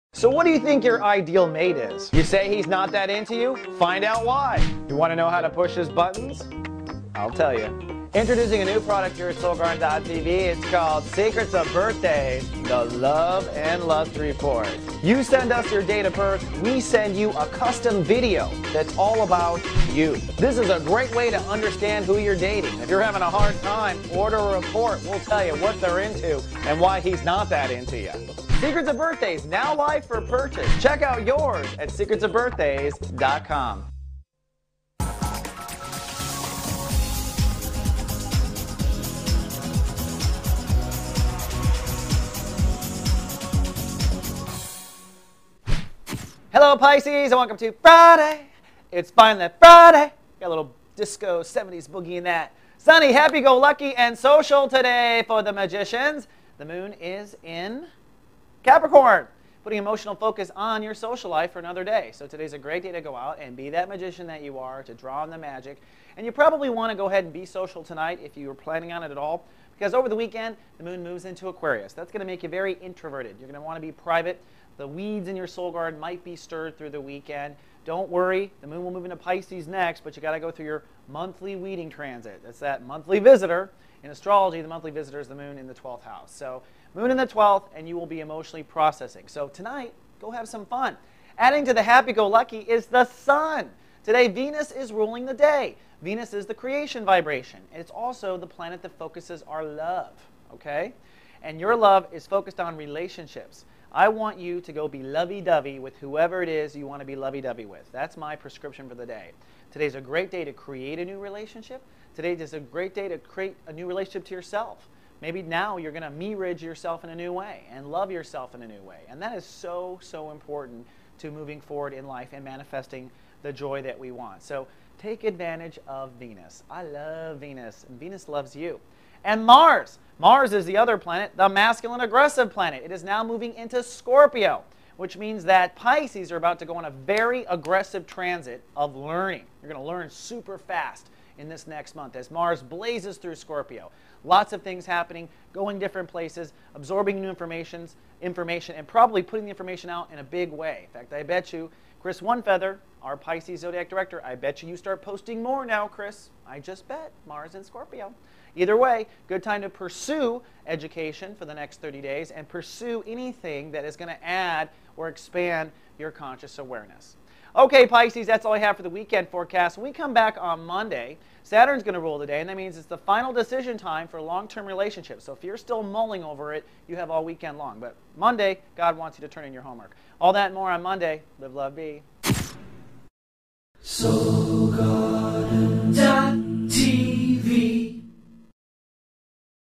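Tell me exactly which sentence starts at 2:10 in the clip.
Mars is the other planet, the masculine aggressive planet.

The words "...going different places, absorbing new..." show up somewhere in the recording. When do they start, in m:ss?
2:25.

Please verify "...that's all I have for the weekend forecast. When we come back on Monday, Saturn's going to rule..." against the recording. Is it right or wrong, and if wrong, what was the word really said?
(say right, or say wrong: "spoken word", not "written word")
right.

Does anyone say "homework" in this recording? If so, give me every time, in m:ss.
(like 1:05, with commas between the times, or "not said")
2:59.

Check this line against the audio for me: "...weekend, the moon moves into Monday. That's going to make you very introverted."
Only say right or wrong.
wrong.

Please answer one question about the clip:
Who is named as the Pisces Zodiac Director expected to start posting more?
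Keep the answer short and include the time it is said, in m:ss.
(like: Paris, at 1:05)
Chris Onefeather, at 2:32.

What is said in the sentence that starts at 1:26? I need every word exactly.
So, moon in the 12th, and you will be emotionally processing.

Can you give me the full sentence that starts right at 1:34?
Today, Venus is ruling the day.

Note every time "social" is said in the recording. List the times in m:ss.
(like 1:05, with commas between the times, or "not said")
0:54, 1:00, 1:07.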